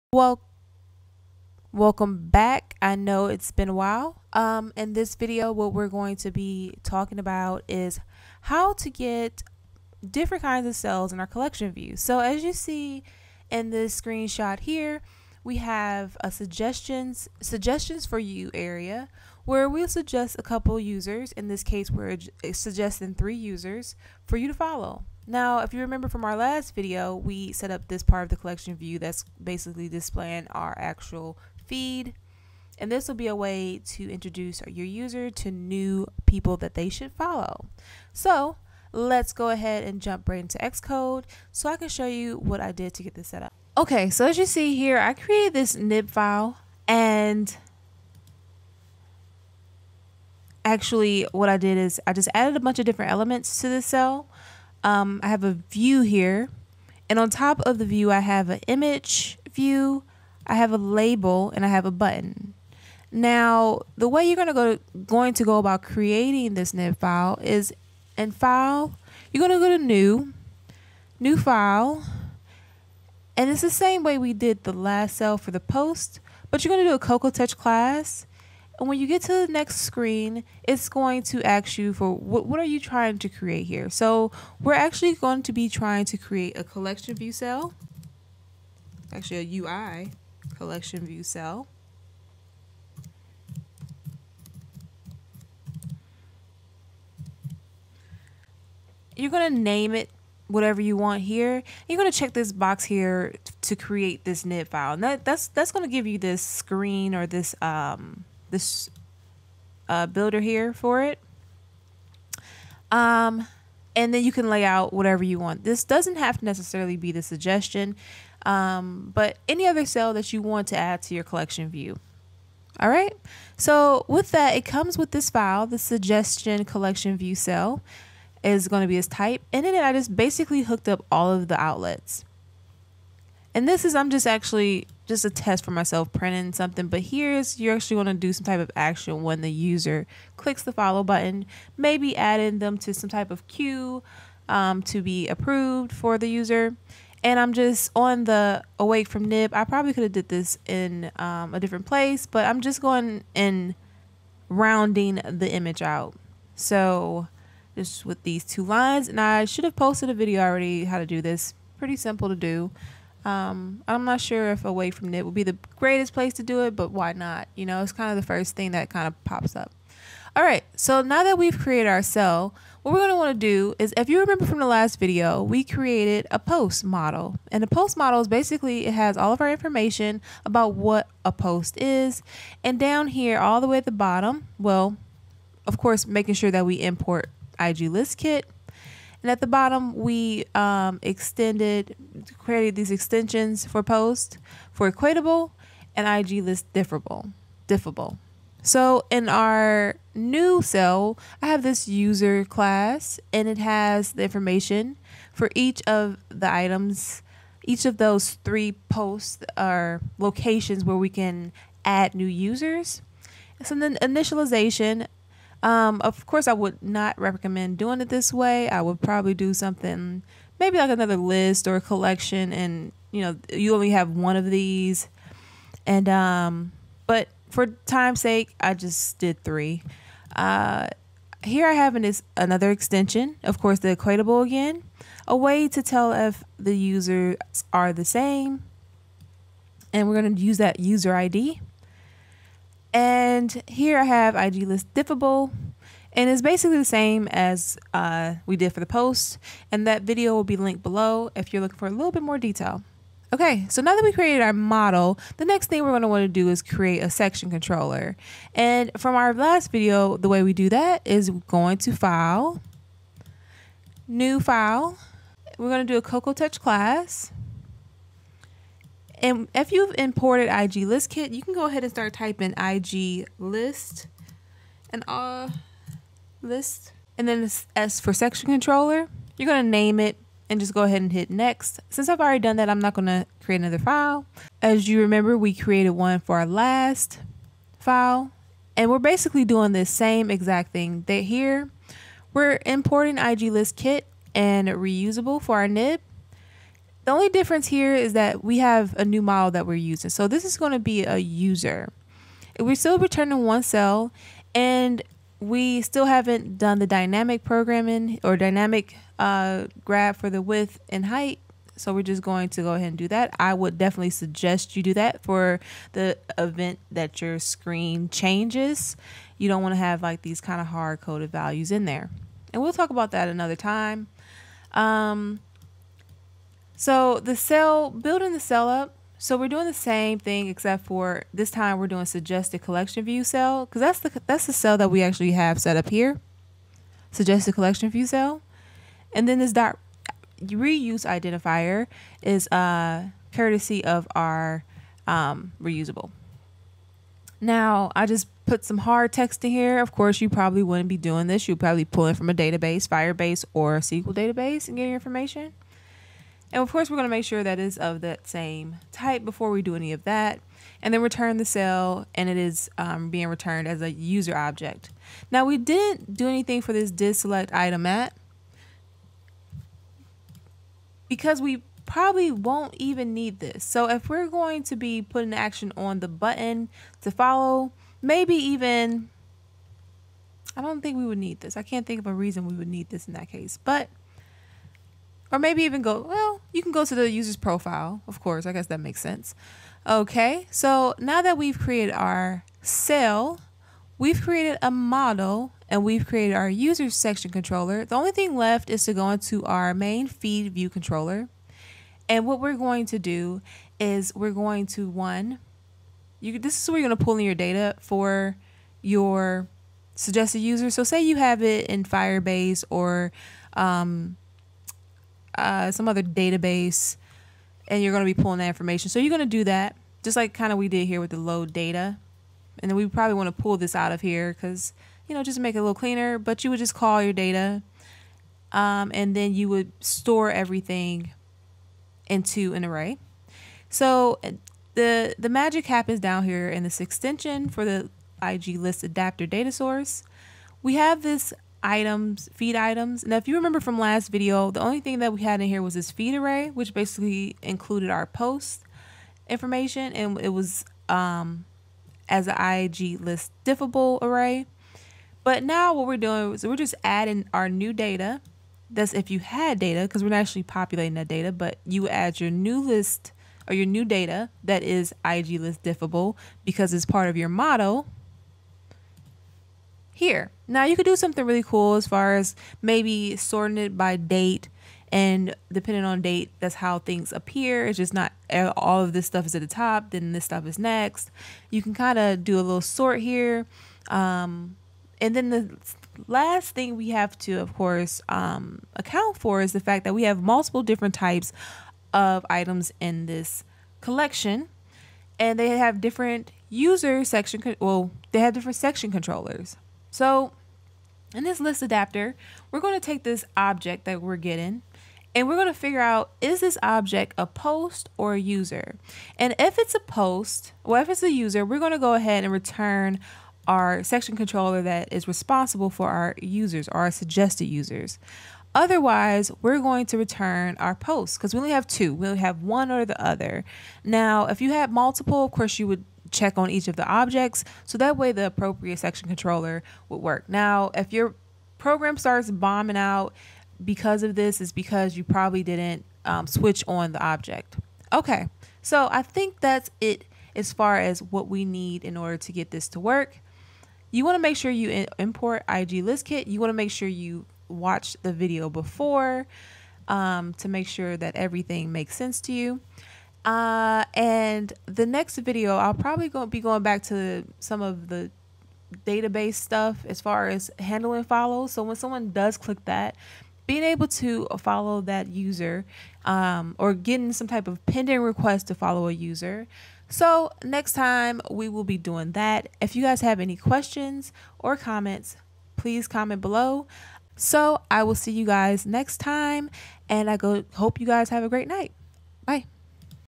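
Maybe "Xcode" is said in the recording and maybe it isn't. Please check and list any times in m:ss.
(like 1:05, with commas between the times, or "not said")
0:40.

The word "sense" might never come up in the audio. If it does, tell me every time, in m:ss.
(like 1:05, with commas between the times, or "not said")
6:29, 9:11.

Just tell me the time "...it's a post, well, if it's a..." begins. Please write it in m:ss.
8:29.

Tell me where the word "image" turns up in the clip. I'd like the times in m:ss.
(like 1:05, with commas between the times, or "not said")
0:58, 2:35.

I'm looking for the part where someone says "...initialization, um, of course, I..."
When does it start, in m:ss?
3:34.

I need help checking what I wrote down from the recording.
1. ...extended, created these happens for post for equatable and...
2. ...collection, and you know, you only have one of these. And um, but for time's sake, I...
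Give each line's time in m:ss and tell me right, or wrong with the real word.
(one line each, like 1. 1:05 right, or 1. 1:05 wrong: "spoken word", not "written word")
1. 3:11 wrong: "extensions", not "happens"
2. 3:41 right.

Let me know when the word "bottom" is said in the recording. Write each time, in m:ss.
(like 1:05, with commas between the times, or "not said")
3:03, 3:09.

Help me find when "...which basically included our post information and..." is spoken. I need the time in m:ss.
7:26.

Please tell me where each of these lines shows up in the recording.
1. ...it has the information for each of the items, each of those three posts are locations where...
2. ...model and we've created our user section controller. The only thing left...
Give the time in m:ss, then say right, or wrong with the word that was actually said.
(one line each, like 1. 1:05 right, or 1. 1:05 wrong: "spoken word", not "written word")
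1. 3:23 right
2. 6:34 right.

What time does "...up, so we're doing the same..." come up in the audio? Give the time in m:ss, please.
5:28.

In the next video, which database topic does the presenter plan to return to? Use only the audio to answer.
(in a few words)
Handling follows.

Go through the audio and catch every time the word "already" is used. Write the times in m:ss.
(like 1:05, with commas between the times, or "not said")
2:40, 4:42.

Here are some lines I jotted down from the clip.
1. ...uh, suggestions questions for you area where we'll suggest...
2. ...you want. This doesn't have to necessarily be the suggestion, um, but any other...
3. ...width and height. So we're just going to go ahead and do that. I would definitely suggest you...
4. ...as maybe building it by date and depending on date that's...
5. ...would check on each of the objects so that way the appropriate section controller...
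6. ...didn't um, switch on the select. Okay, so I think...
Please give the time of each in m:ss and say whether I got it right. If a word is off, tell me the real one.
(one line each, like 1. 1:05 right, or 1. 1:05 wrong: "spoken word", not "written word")
1. 0:16 wrong: "suggestions", not "questions"
2. 1:55 right
3. 5:10 right
4. 7:52 wrong: "sorting", not "building"
5. 8:45 right
6. 8:55 wrong: "object", not "select".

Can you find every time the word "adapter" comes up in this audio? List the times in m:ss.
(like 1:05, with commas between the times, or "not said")
7:18, 8:21.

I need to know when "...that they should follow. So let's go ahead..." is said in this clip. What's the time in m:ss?
0:36.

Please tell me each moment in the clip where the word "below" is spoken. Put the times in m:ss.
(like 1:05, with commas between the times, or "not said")
4:10, 9:36.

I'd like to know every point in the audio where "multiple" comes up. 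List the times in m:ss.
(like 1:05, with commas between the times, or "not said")
8:10, 8:44.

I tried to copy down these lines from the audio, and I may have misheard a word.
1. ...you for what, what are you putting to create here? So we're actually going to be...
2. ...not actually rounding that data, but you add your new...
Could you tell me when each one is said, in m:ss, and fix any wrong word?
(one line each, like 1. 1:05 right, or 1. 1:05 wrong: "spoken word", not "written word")
1. 1:21 wrong: "trying", not "putting"
2. 7:40 wrong: "populating", not "rounding".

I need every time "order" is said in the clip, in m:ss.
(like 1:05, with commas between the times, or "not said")
9:01.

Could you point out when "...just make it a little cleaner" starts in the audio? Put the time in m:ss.
7:05.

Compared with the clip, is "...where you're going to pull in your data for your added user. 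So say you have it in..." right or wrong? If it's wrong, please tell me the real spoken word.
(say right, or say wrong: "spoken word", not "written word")
wrong: "suggested", not "added".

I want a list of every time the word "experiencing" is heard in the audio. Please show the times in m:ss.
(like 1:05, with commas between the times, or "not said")
not said.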